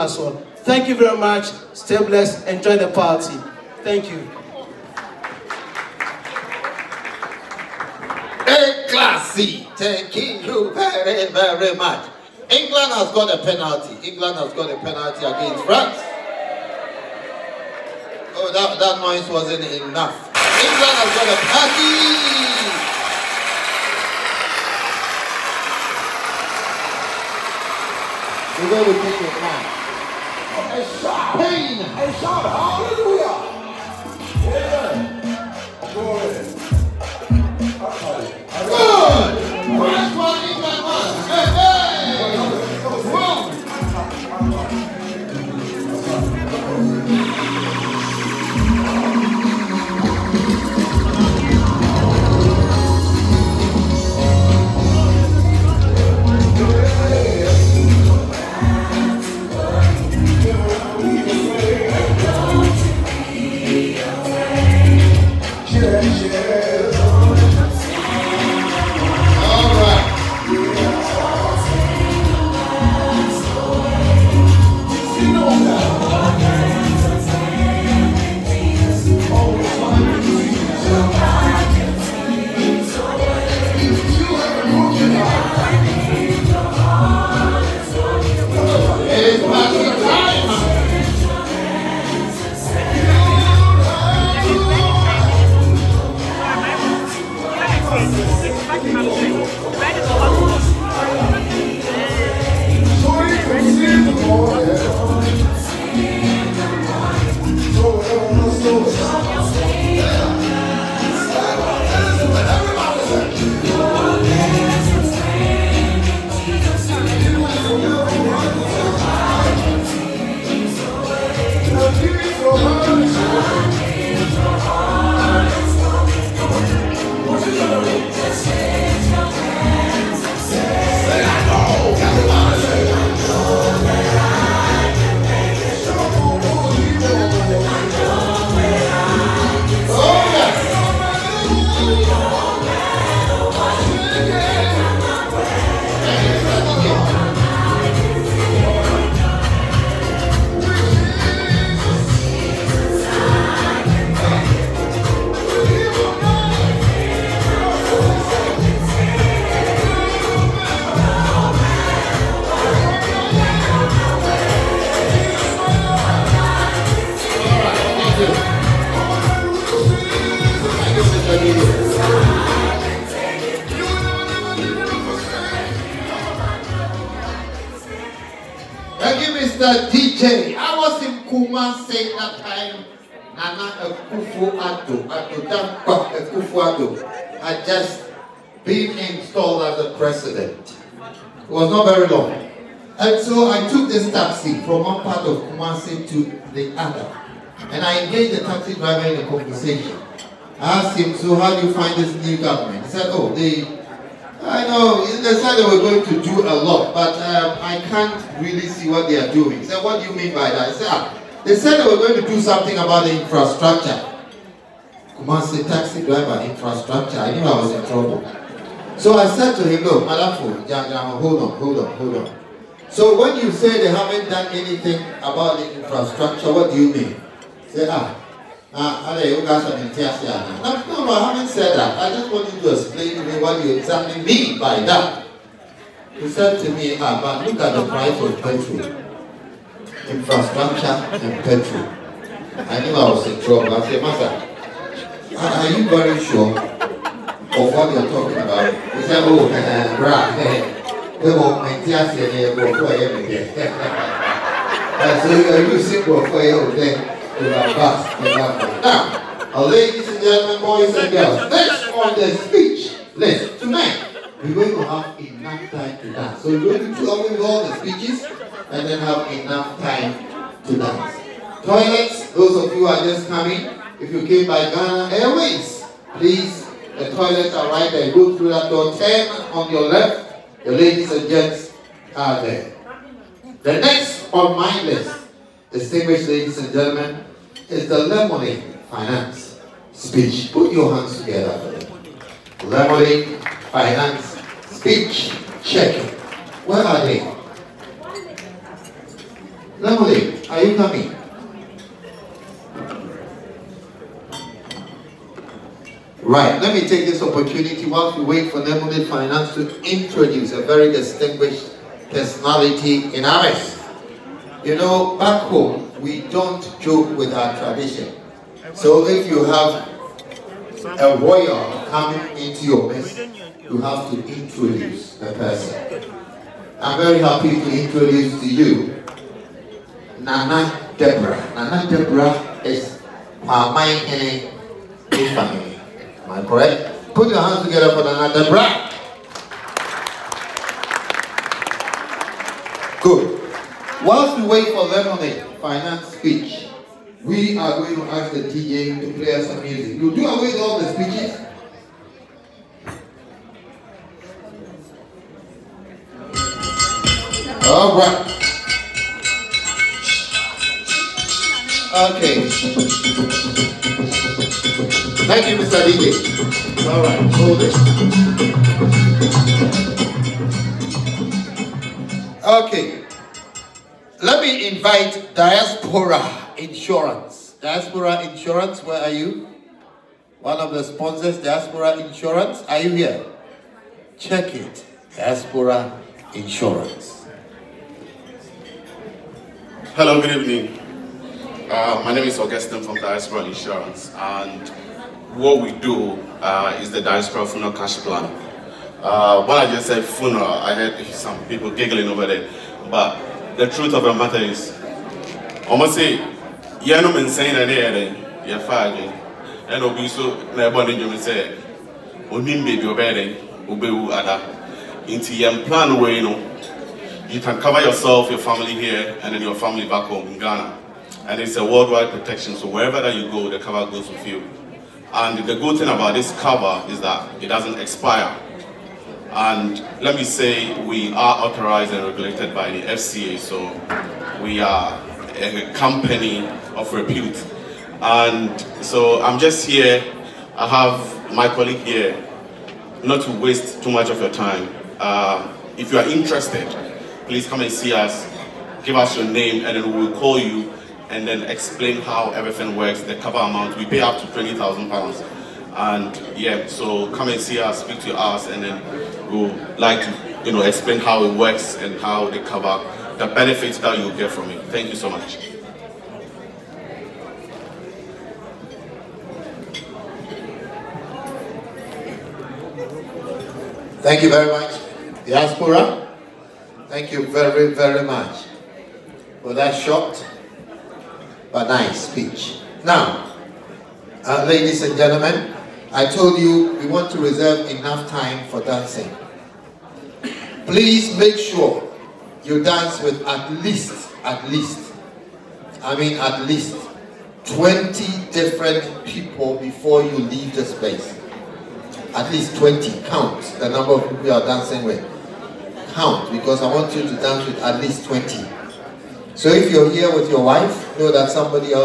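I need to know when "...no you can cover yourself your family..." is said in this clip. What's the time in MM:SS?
06:56.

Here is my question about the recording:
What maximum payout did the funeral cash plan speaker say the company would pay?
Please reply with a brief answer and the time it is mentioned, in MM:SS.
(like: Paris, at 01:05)
£20,000, at 07:34.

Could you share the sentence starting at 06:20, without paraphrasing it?
One of the sponsors, Diaspora Insurance.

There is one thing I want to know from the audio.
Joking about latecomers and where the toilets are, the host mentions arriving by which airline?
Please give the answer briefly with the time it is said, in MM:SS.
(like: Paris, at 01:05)
Ghana Airways, at 04:34.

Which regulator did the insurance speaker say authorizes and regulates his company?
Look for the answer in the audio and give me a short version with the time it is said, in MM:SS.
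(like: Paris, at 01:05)
FCA, at 07:12.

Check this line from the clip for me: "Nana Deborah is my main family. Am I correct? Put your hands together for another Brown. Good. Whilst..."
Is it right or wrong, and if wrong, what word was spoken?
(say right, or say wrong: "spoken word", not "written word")
right.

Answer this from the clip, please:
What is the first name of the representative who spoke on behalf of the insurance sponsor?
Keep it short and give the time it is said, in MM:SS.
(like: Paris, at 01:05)
Augustine, at 06:32.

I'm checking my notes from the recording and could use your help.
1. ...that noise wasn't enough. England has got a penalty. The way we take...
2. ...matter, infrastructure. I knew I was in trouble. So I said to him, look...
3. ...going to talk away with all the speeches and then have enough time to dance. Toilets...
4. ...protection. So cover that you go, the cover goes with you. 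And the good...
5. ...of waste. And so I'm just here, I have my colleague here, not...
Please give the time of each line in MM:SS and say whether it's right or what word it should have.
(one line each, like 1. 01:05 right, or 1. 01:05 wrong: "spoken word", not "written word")
1. 00:18 right
2. 03:36 wrong: "driver", not "matter"
3. 04:26 right
4. 07:02 wrong: "wherever", not "cover"
5. 07:16 wrong: "repute", not "waste".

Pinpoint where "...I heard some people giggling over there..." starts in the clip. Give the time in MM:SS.
06:40.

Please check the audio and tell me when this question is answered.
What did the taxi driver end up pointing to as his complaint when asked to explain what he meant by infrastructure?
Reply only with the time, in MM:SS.
03:57.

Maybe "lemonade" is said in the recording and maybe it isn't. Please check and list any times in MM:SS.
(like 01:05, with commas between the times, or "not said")
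04:48, 04:52, 04:59, 05:08, 05:44.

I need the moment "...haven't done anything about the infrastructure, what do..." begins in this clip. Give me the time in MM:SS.
03:43.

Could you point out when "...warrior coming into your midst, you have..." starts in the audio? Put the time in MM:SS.
05:21.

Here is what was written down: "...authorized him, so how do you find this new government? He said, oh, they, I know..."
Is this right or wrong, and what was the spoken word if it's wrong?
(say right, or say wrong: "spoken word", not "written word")
wrong: "asked", not "authorized".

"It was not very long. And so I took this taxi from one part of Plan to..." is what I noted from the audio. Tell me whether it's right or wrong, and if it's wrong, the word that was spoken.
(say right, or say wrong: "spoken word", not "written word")
wrong: "Kumasi", not "Plan".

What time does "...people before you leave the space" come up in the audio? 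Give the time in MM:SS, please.
08:19.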